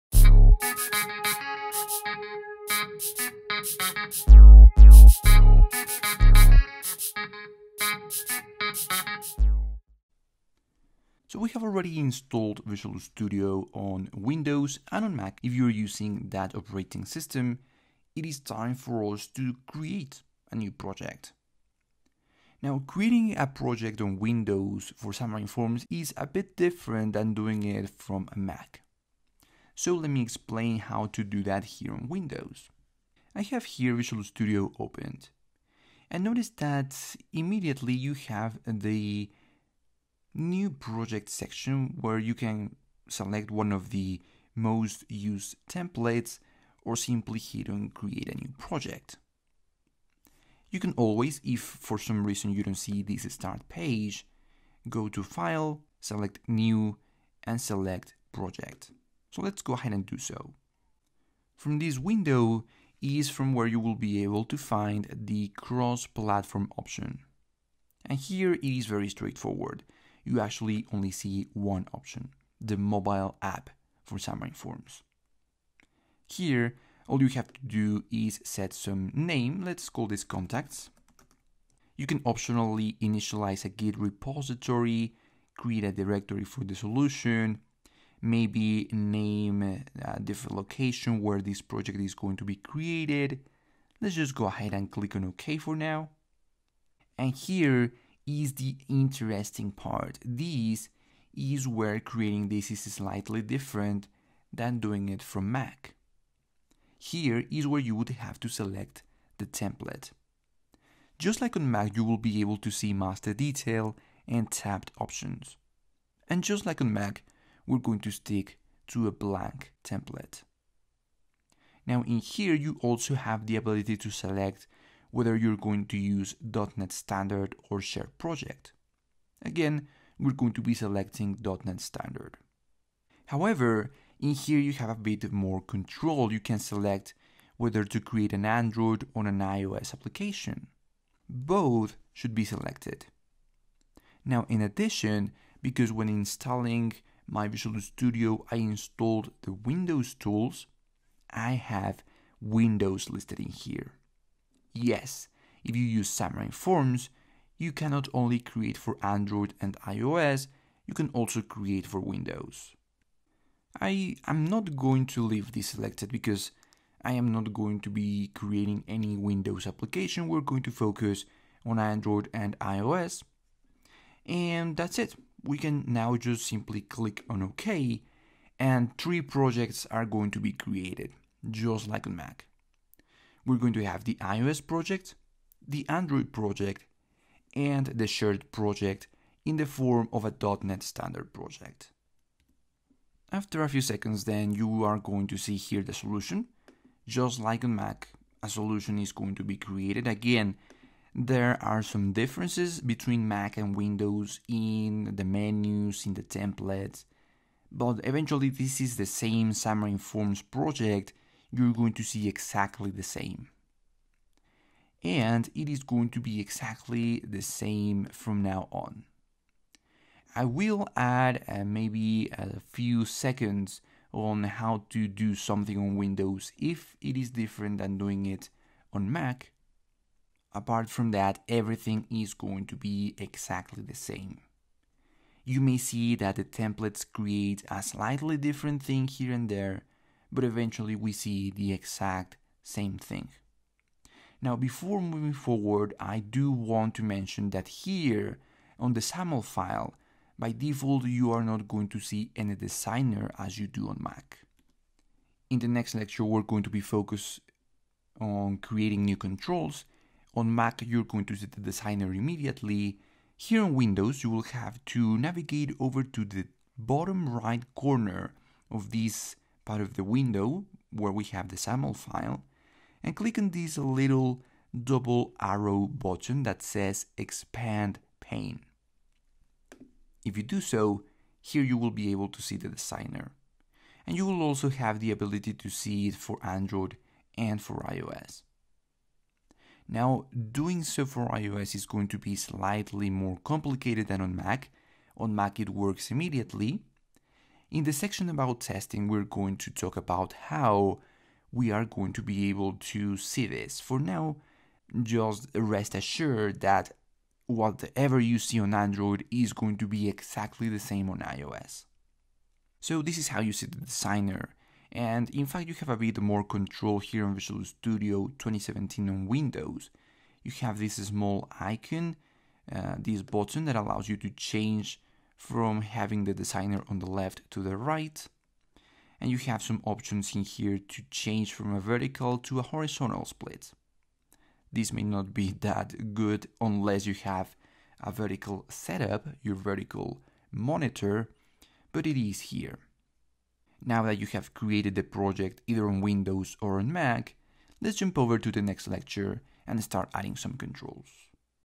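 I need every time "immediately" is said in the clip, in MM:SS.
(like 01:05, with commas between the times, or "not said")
00:37, 04:22, 04:56.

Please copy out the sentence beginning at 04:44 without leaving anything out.
And you will also have the ability to see it for Android and for iOS.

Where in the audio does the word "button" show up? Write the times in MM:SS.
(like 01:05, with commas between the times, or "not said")
04:35, 05:23.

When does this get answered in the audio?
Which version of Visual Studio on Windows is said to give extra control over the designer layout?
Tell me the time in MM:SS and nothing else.
05:17.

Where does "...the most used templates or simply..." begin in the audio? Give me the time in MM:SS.
00:43.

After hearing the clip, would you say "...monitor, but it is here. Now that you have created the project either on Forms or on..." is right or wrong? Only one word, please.
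wrong.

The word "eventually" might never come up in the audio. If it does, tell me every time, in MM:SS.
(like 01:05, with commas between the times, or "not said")
03:28, 04:00.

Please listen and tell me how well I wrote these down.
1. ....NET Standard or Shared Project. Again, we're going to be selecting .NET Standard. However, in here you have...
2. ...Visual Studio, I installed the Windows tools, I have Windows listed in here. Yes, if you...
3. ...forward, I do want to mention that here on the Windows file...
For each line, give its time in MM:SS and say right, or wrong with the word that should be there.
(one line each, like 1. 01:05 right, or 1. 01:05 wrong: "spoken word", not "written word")
1. 02:06 right
2. 02:27 right
3. 04:05 wrong: "XAML", not "Windows".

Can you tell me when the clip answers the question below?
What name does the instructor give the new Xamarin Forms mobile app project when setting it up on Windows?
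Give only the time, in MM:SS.
01:20.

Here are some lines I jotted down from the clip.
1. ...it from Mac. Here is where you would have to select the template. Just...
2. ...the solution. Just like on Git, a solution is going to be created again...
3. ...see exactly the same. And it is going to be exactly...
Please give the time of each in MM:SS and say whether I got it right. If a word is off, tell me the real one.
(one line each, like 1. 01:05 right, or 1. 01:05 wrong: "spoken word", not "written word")
1. 01:45 right
2. 03:15 wrong: "Mac", not "Git"
3. 03:32 right.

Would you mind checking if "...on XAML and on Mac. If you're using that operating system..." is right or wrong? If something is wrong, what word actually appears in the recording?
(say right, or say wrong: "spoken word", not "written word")
wrong: "Windows", not "XAML".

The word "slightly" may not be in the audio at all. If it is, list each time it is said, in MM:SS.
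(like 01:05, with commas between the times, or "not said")
01:42, 03:57, 04:52.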